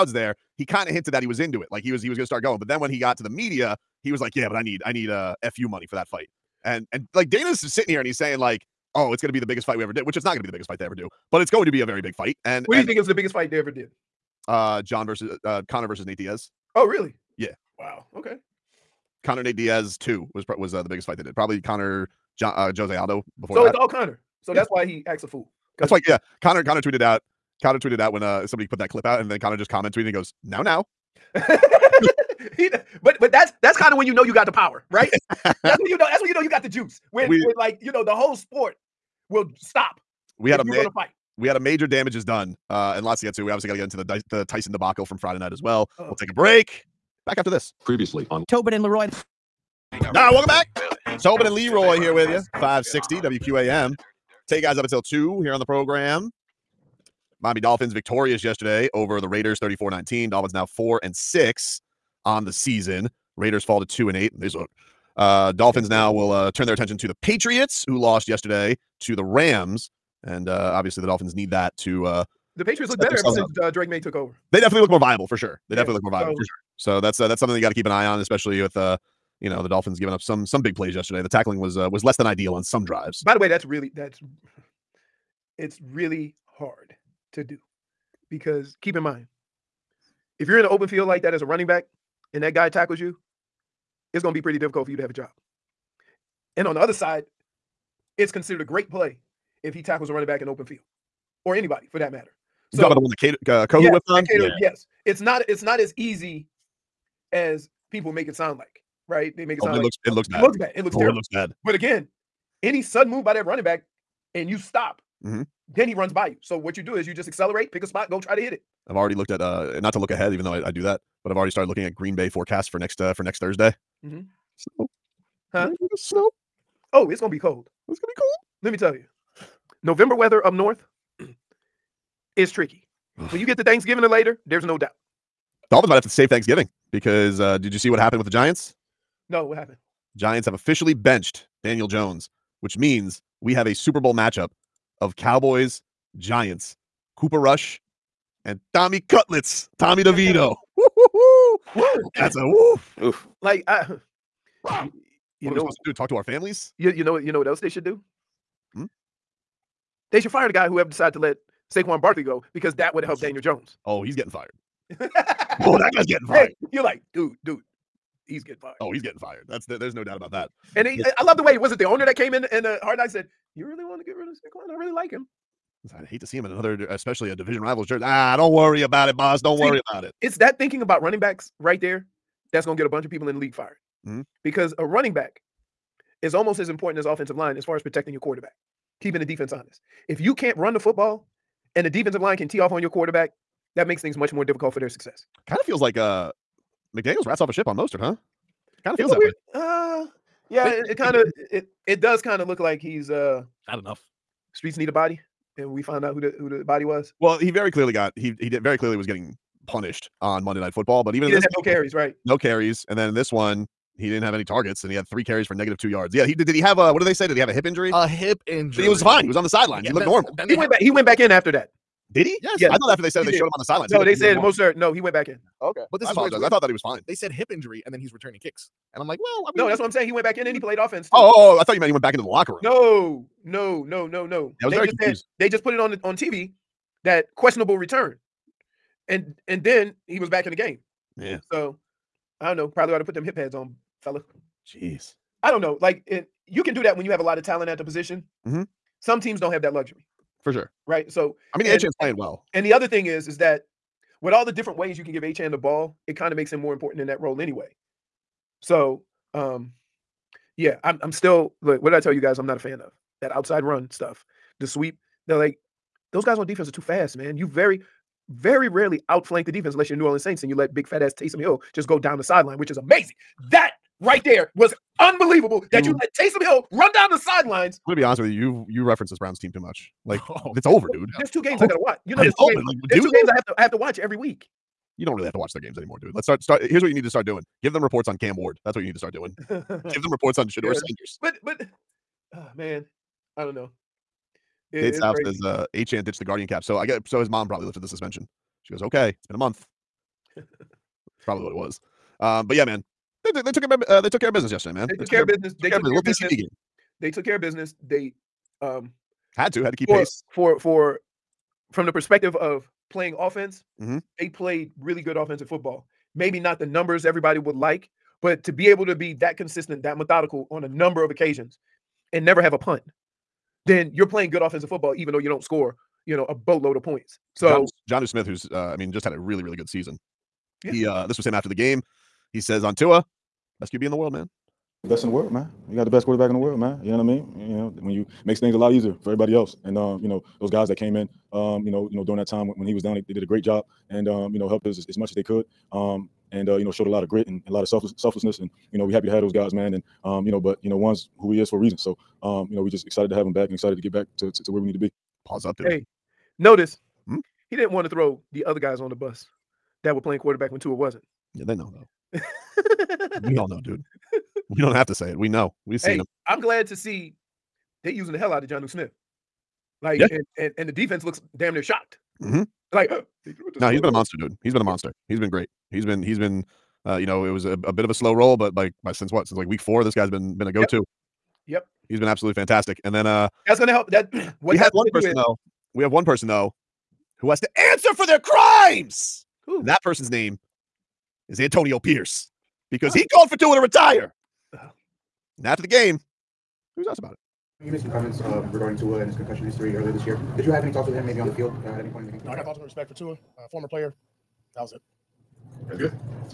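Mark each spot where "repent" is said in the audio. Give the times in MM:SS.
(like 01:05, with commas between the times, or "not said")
not said.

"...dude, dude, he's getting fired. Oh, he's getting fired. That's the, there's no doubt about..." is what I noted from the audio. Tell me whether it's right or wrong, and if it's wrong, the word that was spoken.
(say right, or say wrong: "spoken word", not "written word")
right.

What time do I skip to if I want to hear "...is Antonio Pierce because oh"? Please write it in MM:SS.
06:31.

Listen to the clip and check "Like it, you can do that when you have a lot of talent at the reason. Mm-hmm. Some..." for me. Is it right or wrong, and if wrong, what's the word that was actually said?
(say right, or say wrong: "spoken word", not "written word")
wrong: "position", not "reason".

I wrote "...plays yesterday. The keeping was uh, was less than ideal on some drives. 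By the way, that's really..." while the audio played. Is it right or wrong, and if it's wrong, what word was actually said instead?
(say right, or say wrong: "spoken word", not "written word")
wrong: "tackling", not "keeping".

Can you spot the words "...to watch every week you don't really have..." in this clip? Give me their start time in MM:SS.
04:43.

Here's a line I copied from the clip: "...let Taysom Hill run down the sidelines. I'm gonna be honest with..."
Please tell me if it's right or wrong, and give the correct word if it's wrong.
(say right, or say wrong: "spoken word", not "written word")
right.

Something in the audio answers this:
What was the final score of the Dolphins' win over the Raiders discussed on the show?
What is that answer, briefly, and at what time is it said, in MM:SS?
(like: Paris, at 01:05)
34-19, at 00:59.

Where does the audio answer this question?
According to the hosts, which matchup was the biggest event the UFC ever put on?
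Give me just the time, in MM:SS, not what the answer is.
00:19.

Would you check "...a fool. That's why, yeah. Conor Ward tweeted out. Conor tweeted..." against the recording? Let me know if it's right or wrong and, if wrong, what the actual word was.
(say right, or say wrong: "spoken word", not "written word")
wrong: "Conor", not "Ward".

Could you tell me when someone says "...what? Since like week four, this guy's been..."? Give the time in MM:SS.
06:19.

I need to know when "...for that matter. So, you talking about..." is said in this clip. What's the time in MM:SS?
01:41.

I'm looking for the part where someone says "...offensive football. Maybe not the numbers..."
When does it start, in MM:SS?
05:15.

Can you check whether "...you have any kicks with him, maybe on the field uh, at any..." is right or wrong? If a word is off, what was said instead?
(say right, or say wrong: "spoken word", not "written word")
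wrong: "talks", not "kicks".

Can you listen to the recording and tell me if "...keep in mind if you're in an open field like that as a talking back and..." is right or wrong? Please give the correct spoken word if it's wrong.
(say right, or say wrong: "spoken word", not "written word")
wrong: "running", not "talking".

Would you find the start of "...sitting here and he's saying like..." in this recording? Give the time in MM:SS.
00:07.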